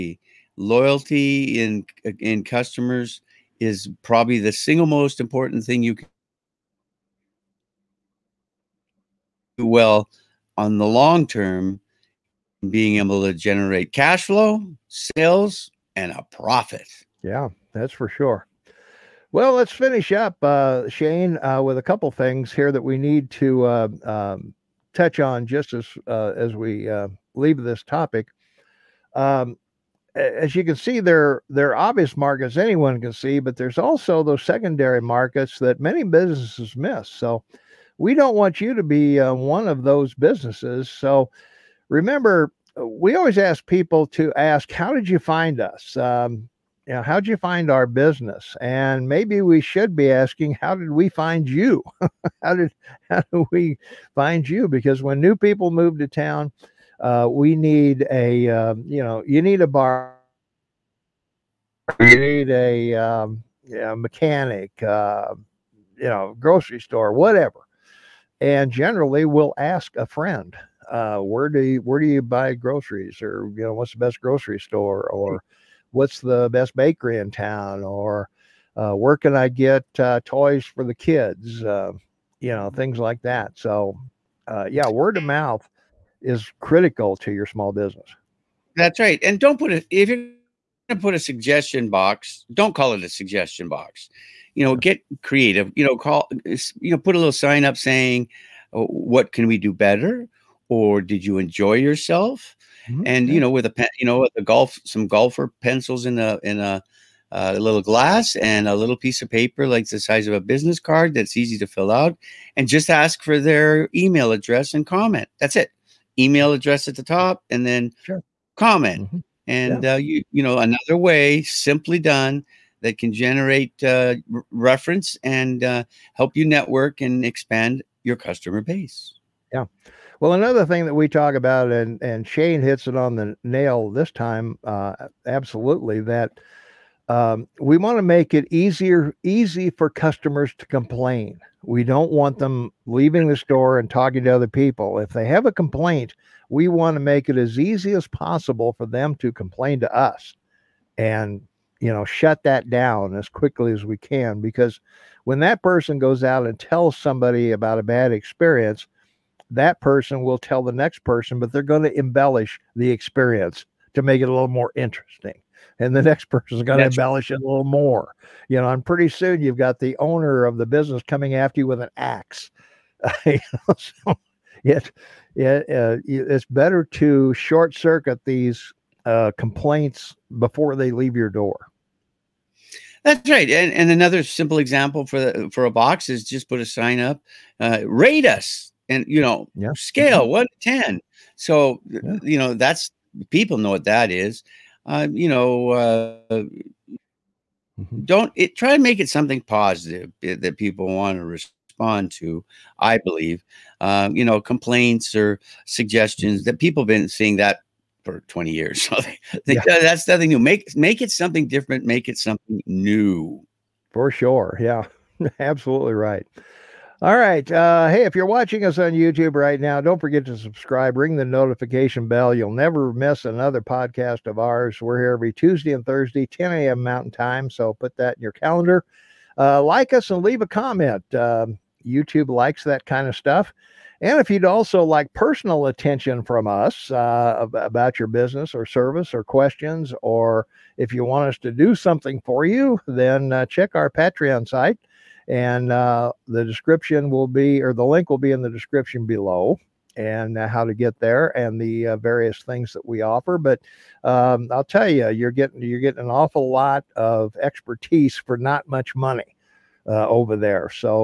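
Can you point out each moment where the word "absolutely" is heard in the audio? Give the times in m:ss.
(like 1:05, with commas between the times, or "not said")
2:15, 3:35.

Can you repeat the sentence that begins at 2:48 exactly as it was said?
You know, and pretty soon you've got the owner of the business coming after you with an axe.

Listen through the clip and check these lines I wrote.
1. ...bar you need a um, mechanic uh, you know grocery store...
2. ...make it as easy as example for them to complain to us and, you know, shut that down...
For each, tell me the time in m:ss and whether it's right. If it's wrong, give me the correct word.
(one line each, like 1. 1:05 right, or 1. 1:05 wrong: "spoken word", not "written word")
1. 0:59 right
2. 2:27 wrong: "possible", not "example".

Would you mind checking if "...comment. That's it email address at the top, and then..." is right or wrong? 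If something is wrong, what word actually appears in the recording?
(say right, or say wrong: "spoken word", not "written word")
right.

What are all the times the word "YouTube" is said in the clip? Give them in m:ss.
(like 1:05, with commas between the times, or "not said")
3:38, 3:51.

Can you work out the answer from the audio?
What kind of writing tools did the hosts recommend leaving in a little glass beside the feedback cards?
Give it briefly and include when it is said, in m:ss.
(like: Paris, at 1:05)
Golfer pencils, at 1:45.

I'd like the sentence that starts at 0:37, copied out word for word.
So we don't want you to be uh, one of those businesses.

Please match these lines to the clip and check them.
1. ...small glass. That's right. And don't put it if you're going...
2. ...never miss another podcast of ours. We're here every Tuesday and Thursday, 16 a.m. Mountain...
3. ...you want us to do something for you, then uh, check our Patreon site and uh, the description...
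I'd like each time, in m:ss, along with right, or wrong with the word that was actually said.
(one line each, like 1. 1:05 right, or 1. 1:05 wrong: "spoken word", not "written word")
1. 1:27 wrong: "business", not "glass"
2. 3:42 wrong: "10", not "16"
3. 4:00 right.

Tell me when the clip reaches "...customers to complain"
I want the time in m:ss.
2:19.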